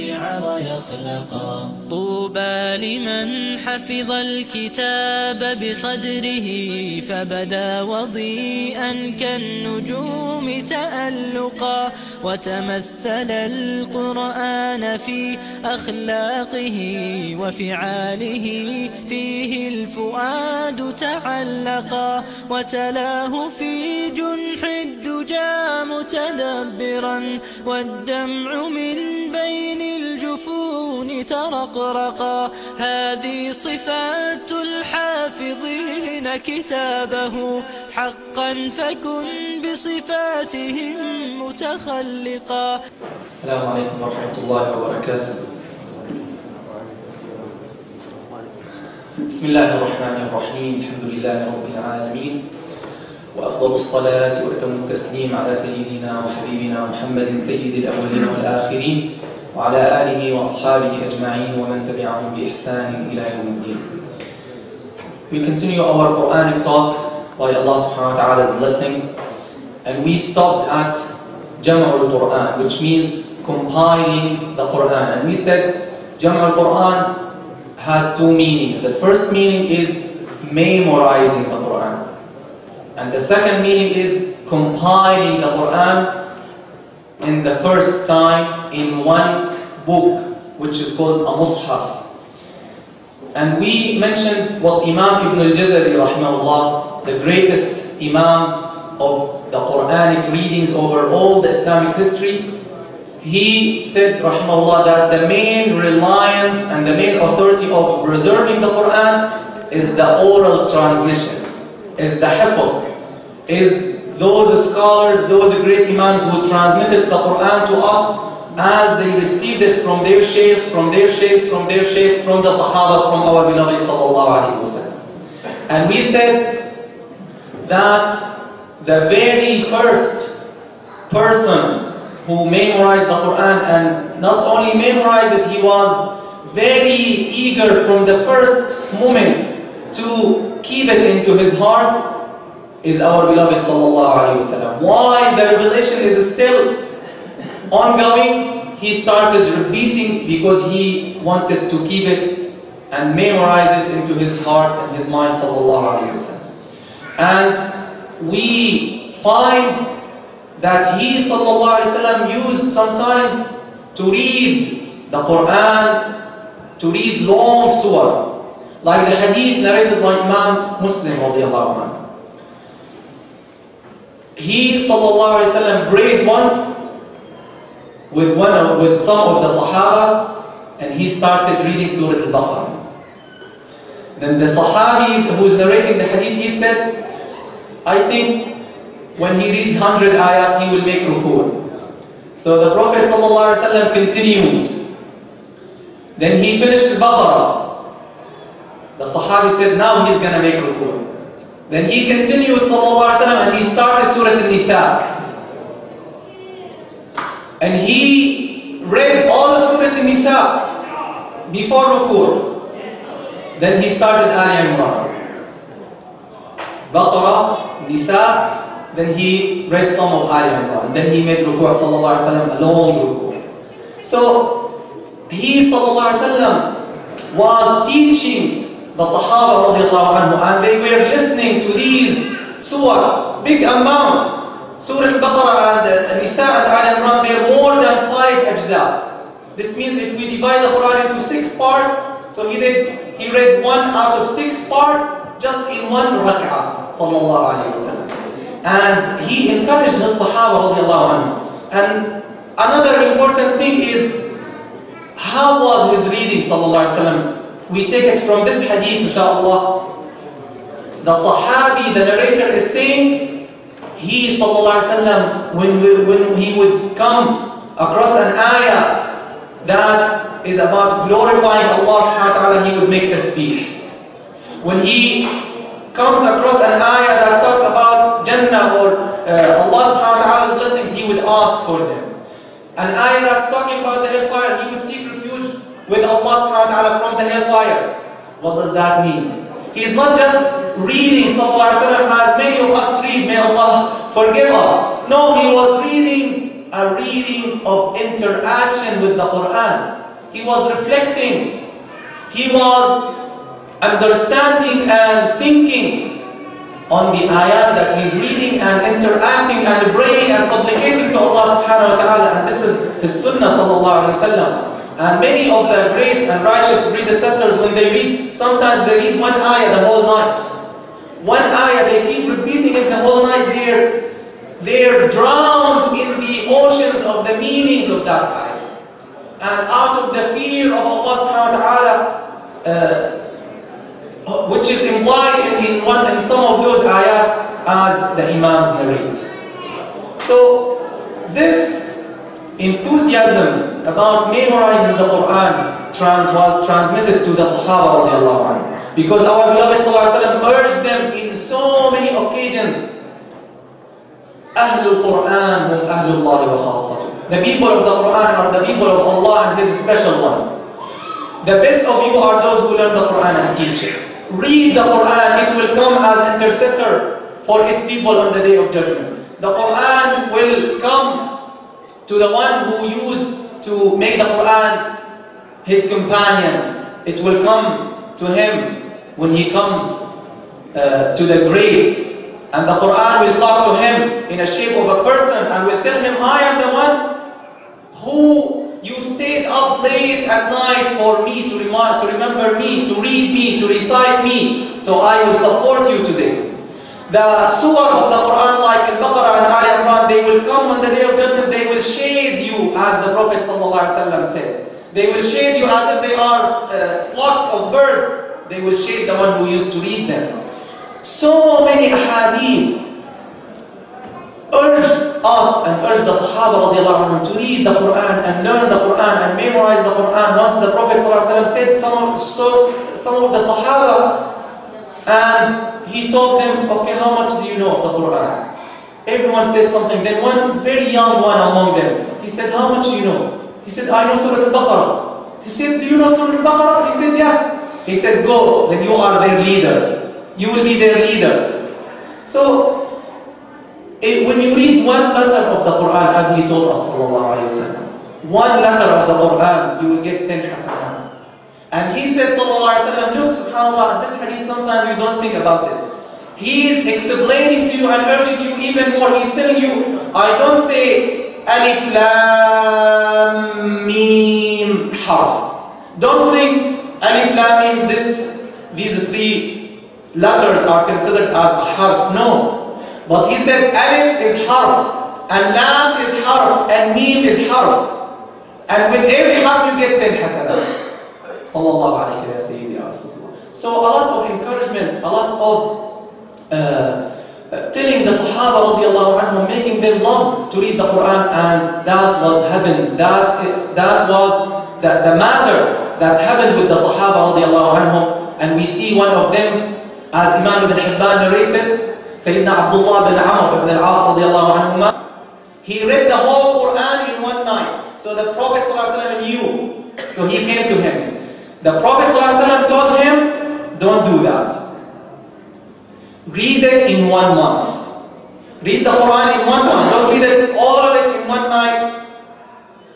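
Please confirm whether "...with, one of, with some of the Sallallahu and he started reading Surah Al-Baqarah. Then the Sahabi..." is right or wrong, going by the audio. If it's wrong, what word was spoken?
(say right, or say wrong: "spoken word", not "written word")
wrong: "Sahaba", not "Sallallahu".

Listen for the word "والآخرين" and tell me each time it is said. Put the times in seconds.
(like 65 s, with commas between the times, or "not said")
58 s.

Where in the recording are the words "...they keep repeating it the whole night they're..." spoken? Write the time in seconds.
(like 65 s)
321 s.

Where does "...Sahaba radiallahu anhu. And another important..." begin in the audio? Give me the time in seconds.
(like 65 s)
250 s.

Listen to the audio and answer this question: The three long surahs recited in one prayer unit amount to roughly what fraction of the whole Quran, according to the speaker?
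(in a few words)
one out of six.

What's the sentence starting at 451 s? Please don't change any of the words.
And he said, وسلم, look, subhanAllah, this hadith sometimes you don't think about it.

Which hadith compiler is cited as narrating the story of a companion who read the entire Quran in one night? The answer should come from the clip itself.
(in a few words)
Ibn Hibban.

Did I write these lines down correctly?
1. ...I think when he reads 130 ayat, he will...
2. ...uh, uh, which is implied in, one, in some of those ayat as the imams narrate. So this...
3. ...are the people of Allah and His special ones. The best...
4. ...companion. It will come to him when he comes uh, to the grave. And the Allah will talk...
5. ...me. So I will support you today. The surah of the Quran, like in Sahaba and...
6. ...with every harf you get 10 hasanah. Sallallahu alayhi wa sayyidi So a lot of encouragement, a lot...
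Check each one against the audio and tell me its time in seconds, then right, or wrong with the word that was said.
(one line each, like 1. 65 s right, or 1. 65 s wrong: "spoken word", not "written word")
1. 187 s wrong: "100", not "130"
2. 332 s right
3. 358 s right
4. 375 s wrong: "Quran", not "Allah"
5. 394 s wrong: "Baqarah", not "Sahaba"
6. 478 s right.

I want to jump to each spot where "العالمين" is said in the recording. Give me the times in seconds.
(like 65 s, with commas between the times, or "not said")
51 s.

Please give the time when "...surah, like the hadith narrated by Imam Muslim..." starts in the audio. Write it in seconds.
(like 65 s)
167 s.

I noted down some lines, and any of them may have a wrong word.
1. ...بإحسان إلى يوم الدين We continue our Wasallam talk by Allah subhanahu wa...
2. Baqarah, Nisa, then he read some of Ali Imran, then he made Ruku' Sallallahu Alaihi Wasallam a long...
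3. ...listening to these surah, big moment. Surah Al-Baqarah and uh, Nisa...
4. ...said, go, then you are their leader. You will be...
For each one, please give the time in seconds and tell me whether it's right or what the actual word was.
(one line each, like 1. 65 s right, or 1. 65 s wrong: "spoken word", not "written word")
1. 62 s wrong: "Quranic", not "Wasallam"
2. 216 s right
3. 231 s wrong: "amount", not "moment"
4. 437 s right.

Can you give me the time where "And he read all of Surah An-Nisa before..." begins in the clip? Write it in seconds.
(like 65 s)
207 s.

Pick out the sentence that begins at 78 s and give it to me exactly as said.
The first meaning is memorizing the Quran.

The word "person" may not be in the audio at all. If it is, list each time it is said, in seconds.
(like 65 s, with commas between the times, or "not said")
131 s, 385 s.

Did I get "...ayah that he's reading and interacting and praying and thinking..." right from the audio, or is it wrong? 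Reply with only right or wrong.
wrong.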